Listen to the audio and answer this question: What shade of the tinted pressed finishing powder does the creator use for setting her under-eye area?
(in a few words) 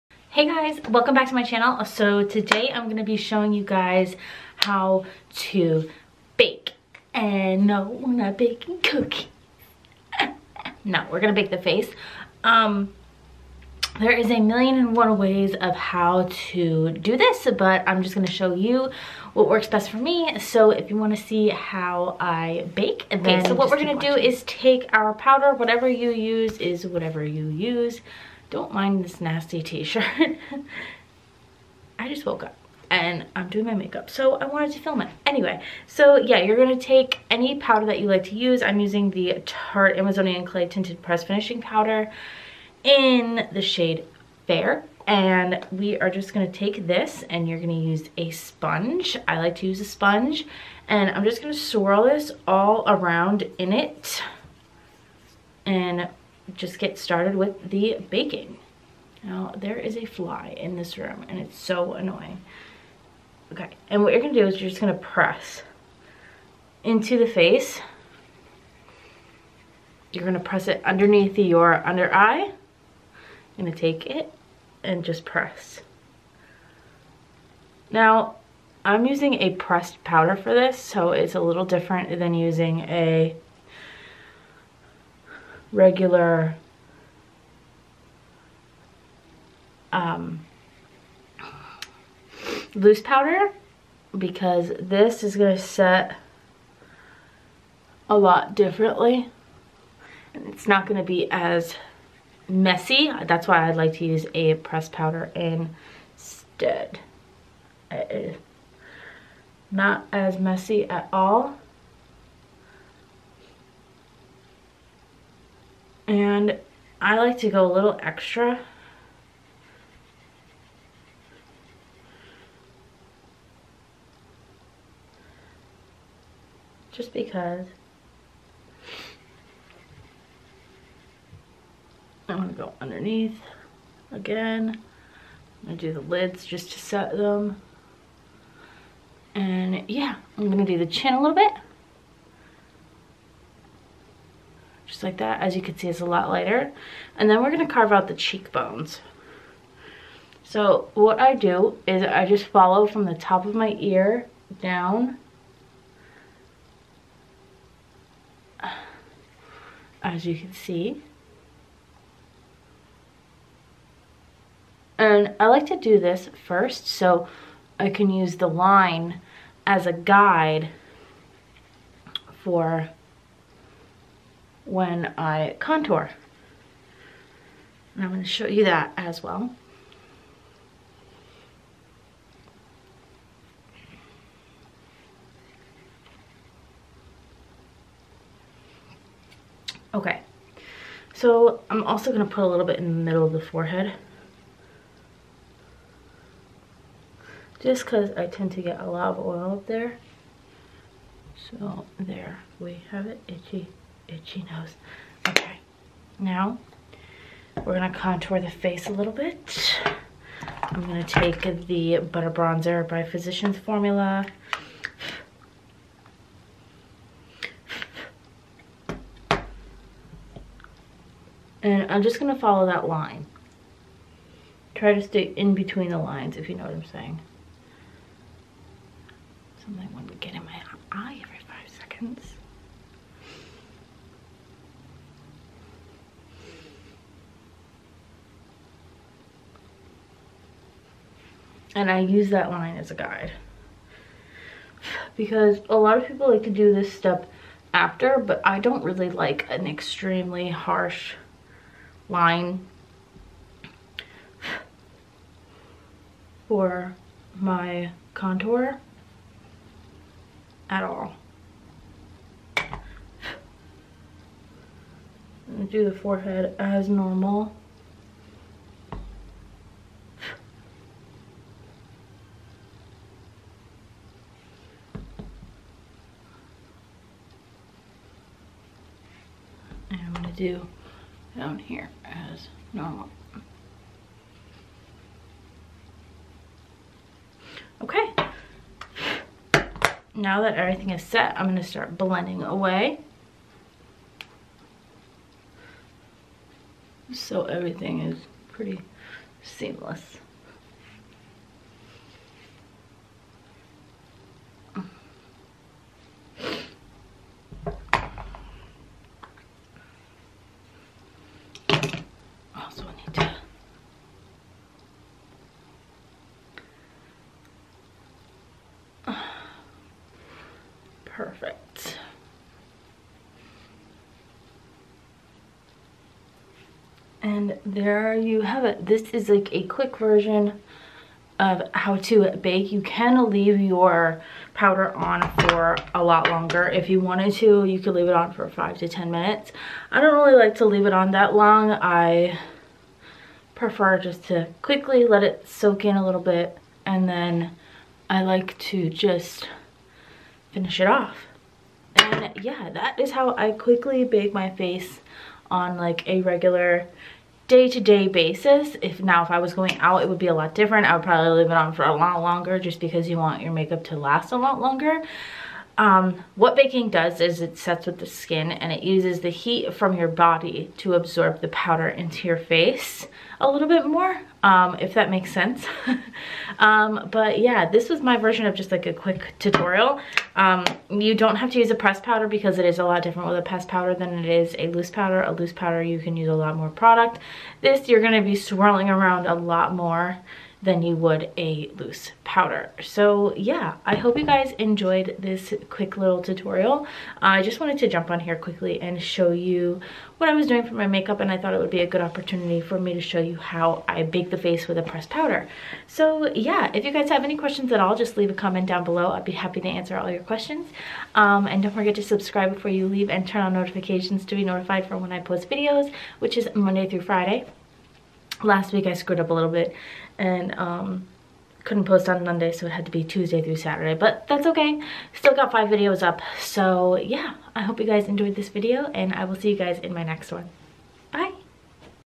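Fair.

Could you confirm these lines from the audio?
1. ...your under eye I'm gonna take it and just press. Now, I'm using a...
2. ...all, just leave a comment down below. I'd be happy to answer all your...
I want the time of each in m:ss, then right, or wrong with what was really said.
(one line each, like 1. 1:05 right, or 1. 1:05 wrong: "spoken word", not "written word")
1. 1:11 right
2. 6:47 right.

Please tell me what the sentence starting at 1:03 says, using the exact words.
Okay, and what you're gonna do is you're just gonna press into the face.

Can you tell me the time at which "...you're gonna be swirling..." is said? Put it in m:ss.
6:27.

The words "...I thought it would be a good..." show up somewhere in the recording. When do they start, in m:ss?
6:41.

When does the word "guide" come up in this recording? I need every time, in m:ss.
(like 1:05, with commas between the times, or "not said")
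2:49, 4:02.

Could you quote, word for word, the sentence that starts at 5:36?
If you wanted to, you could leave it on for five to 10 minutes.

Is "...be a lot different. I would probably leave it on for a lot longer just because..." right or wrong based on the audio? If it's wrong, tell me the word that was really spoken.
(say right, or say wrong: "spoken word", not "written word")
right.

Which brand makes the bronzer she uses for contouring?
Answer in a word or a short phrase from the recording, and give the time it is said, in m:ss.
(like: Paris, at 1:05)
Physicians Formula, at 3:33.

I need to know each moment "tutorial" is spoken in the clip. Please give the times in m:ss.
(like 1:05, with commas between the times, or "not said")
6:19, 6:36.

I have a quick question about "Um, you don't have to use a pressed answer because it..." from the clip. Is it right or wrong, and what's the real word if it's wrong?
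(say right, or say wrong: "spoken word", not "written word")
wrong: "powder", not "answer".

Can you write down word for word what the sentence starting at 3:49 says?
Something would get in my eye every five seconds.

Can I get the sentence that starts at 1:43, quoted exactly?
That's why I'd like to use a pressed powder instead.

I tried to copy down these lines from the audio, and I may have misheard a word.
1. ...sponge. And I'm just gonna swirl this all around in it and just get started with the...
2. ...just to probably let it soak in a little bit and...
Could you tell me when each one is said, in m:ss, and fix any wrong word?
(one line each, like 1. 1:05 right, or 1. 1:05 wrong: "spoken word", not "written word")
1. 0:49 right
2. 5:43 wrong: "quickly", not "probably".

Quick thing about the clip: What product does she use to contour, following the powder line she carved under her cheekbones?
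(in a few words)
Butter Bronzer.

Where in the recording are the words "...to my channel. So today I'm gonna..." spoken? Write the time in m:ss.
0:01.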